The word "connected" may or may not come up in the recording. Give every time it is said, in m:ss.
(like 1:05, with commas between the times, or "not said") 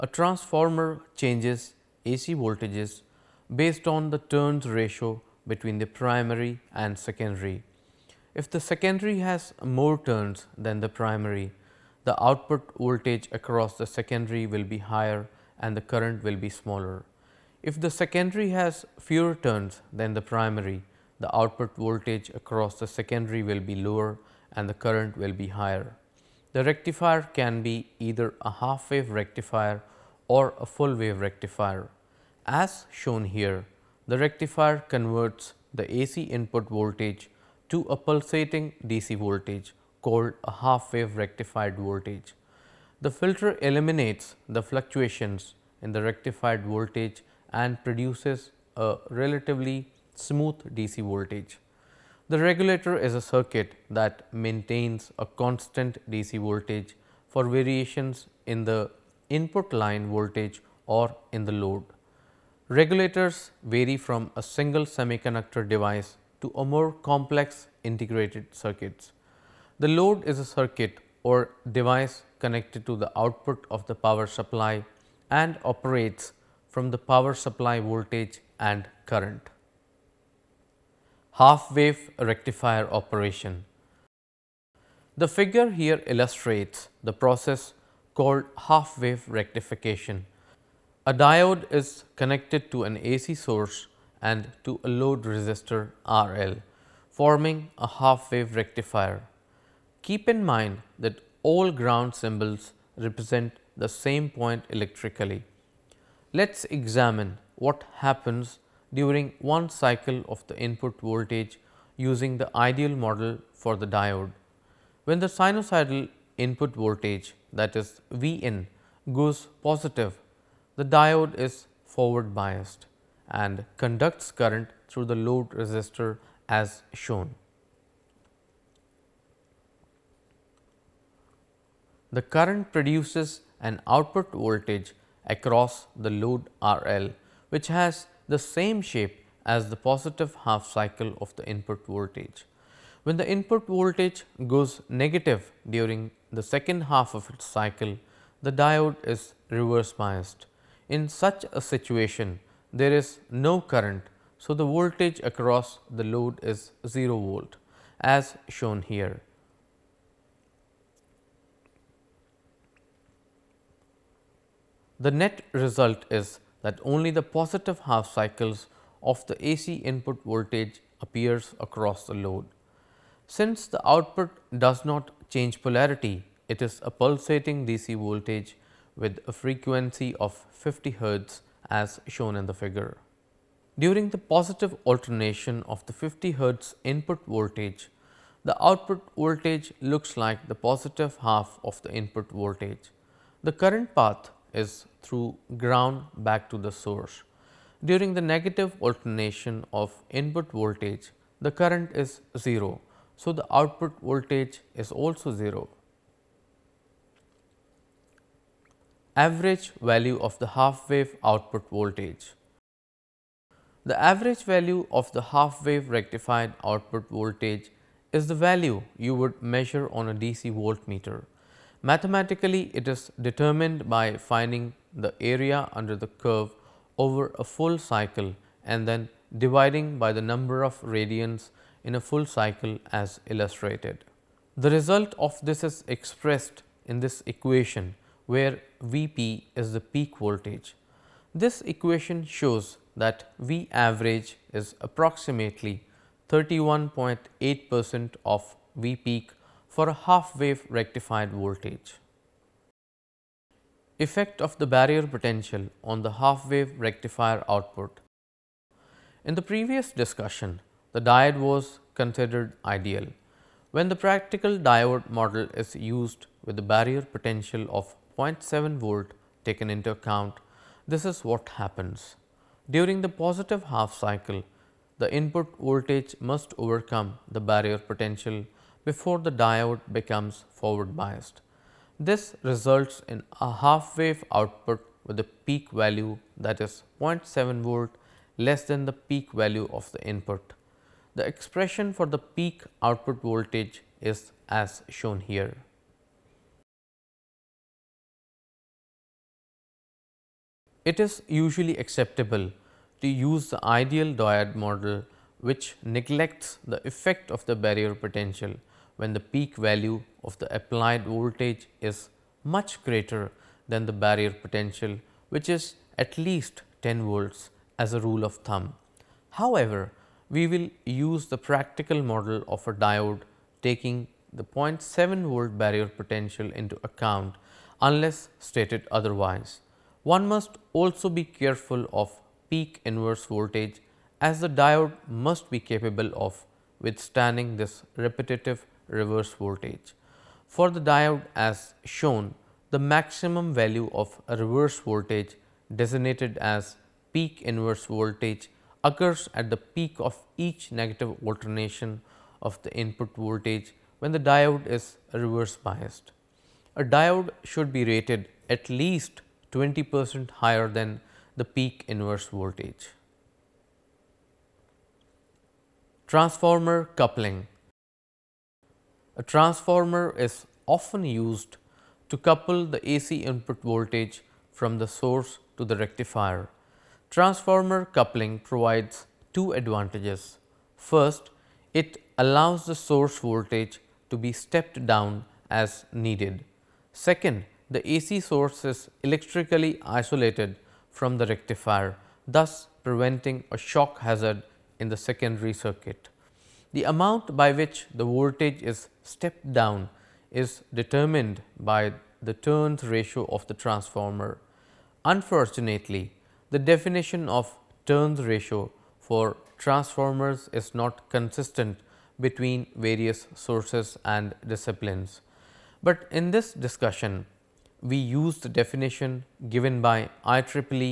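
1:12, 1:32.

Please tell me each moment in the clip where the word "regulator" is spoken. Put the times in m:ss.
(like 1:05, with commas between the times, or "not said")
0:52, 1:02.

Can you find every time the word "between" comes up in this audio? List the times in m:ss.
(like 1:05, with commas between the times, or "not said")
0:05, 6:52.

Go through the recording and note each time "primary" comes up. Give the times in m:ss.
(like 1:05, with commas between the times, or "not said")
0:05, 0:10, 0:20.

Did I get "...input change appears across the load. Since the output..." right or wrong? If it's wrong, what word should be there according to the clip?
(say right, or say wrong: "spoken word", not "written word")
wrong: "voltage", not "change".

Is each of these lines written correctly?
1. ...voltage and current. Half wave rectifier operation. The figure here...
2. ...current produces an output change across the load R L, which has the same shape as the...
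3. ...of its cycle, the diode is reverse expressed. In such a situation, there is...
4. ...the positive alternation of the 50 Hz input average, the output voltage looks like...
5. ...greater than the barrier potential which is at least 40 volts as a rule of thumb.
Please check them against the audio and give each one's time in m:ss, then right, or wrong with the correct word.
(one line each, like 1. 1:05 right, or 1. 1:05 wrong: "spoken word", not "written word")
1. 1:17 right
2. 2:12 wrong: "voltage", not "change"
3. 2:27 wrong: "biased", not "expressed"
4. 3:04 wrong: "voltage", not "average"
5. 5:12 wrong: "10", not "40".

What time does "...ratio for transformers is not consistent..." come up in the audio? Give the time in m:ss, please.
6:48.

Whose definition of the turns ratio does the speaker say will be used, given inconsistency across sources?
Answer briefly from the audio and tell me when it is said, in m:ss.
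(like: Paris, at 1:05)
IEEE, at 7:00.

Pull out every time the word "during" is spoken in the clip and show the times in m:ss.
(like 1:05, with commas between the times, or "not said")
1:48, 2:25, 3:03, 3:17, 4:32.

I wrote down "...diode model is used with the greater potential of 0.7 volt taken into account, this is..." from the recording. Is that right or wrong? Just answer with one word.
wrong.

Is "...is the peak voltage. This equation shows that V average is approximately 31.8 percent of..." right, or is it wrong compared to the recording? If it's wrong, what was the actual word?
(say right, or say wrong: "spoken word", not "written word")
right.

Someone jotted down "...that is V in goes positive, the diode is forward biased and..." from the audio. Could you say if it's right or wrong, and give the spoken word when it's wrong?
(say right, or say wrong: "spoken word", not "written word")
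right.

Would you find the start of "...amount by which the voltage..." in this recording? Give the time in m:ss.
6:36.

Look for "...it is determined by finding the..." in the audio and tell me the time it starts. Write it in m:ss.
3:42.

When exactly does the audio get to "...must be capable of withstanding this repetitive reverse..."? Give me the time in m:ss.
5:35.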